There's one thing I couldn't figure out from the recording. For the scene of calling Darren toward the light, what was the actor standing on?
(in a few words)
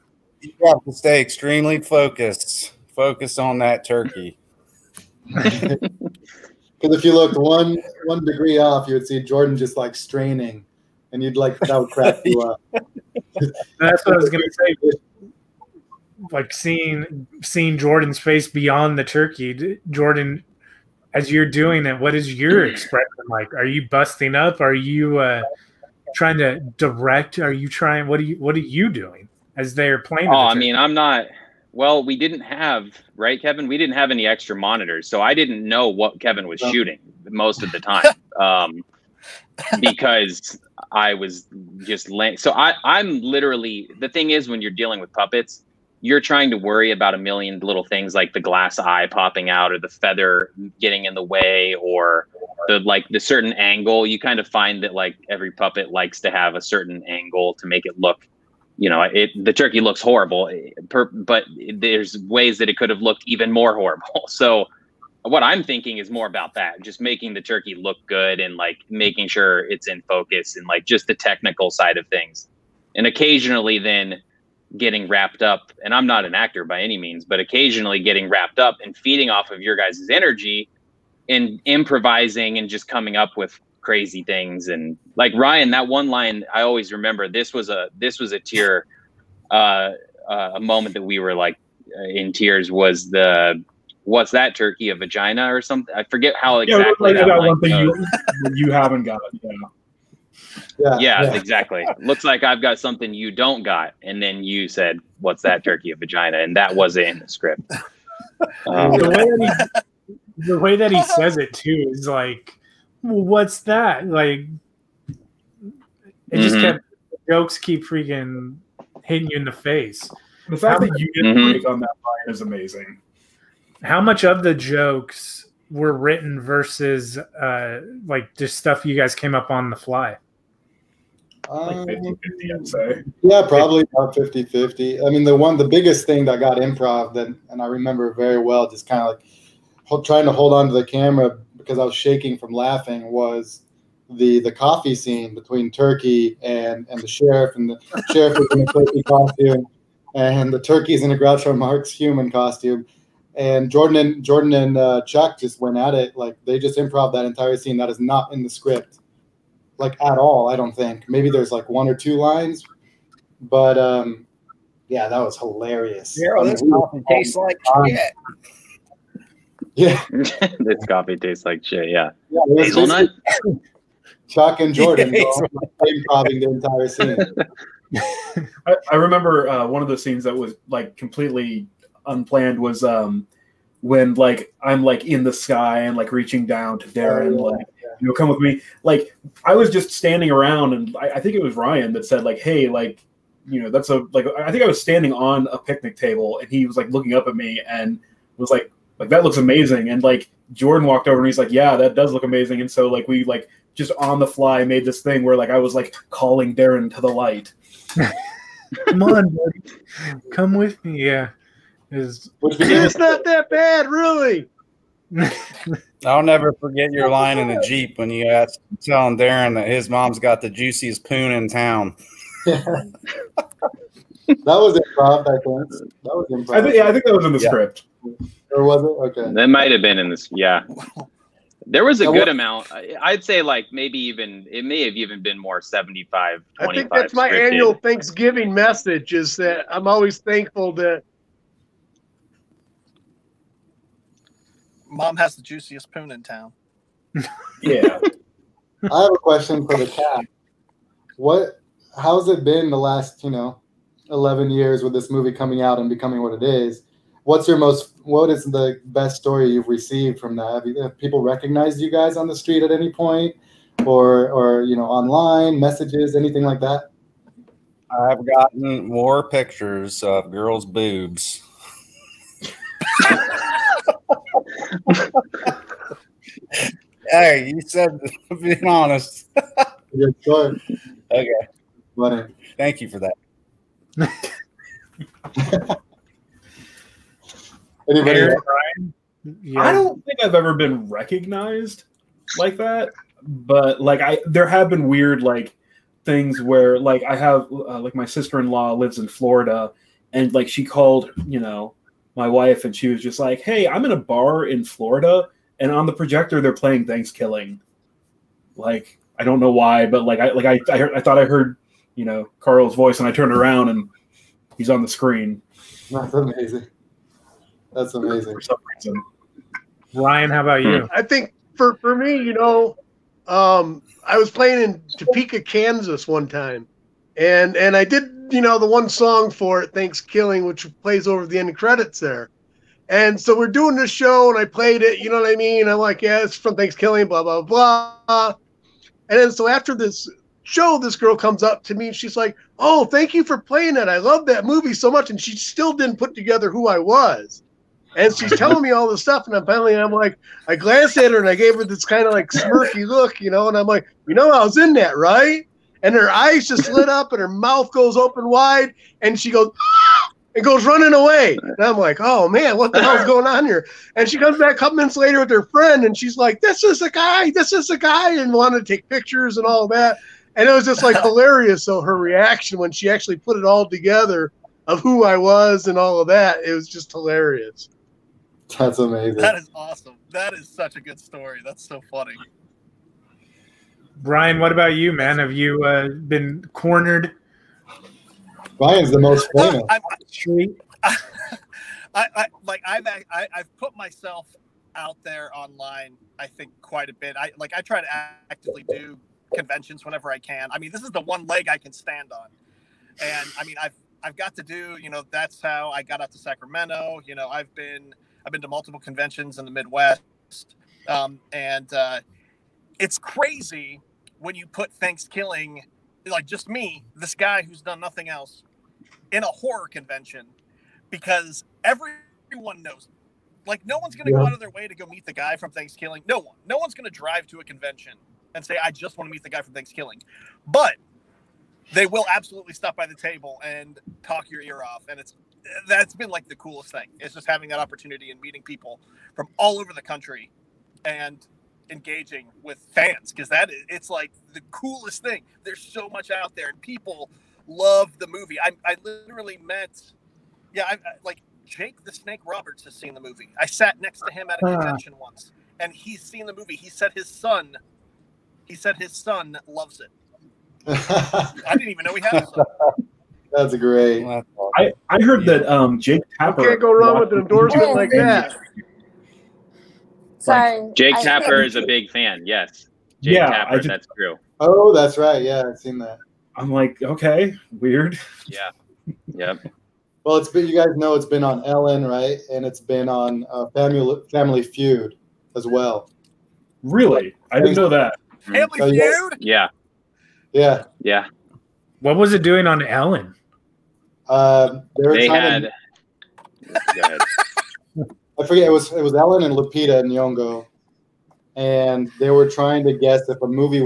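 a picnic table.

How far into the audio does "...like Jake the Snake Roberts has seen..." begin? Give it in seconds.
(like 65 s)
451 s.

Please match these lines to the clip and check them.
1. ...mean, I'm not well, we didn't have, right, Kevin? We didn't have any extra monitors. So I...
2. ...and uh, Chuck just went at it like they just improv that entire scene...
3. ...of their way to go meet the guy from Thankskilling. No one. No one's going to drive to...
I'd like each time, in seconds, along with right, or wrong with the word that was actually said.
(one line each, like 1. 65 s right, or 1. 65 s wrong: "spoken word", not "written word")
1. 30 s right
2. 154 s right
3. 424 s right.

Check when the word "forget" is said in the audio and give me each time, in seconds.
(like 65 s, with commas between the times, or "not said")
96 s, 216 s, 498 s.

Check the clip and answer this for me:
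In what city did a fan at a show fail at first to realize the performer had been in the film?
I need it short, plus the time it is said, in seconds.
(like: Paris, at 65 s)
Topeka, Kansas, at 324 s.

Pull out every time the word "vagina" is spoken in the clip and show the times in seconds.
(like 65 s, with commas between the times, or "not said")
94 s, 105 s.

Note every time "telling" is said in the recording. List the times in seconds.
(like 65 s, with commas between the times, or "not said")
218 s, 348 s.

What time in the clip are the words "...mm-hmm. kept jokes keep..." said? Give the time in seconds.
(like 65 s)
116 s.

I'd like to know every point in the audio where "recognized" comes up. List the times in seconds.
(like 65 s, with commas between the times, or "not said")
261 s, 290 s.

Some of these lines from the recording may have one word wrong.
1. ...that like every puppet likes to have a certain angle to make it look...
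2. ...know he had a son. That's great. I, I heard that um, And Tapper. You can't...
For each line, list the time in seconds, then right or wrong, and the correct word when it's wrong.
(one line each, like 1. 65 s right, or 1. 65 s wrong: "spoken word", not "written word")
1. 54 s right
2. 461 s wrong: "Jake", not "And".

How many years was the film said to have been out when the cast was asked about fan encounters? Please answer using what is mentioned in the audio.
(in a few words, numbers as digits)
11.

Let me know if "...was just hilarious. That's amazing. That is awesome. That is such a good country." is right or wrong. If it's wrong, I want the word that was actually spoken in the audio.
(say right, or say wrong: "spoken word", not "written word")
wrong: "story", not "country".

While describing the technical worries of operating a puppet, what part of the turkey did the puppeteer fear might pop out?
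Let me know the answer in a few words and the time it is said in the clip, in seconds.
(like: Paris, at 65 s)
glass eye, at 48 s.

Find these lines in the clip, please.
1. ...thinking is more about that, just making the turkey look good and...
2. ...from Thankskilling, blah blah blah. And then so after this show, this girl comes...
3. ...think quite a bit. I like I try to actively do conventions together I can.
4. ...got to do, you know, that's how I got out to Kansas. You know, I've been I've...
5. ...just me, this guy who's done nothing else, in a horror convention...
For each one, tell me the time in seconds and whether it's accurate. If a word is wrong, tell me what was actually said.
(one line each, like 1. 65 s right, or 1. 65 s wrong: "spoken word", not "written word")
1. 65 s right
2. 336 s right
3. 396 s wrong: "whenever", not "together"
4. 404 s wrong: "Sacramento", not "Kansas"
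5. 416 s right.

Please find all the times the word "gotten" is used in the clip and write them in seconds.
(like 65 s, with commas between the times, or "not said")
268 s.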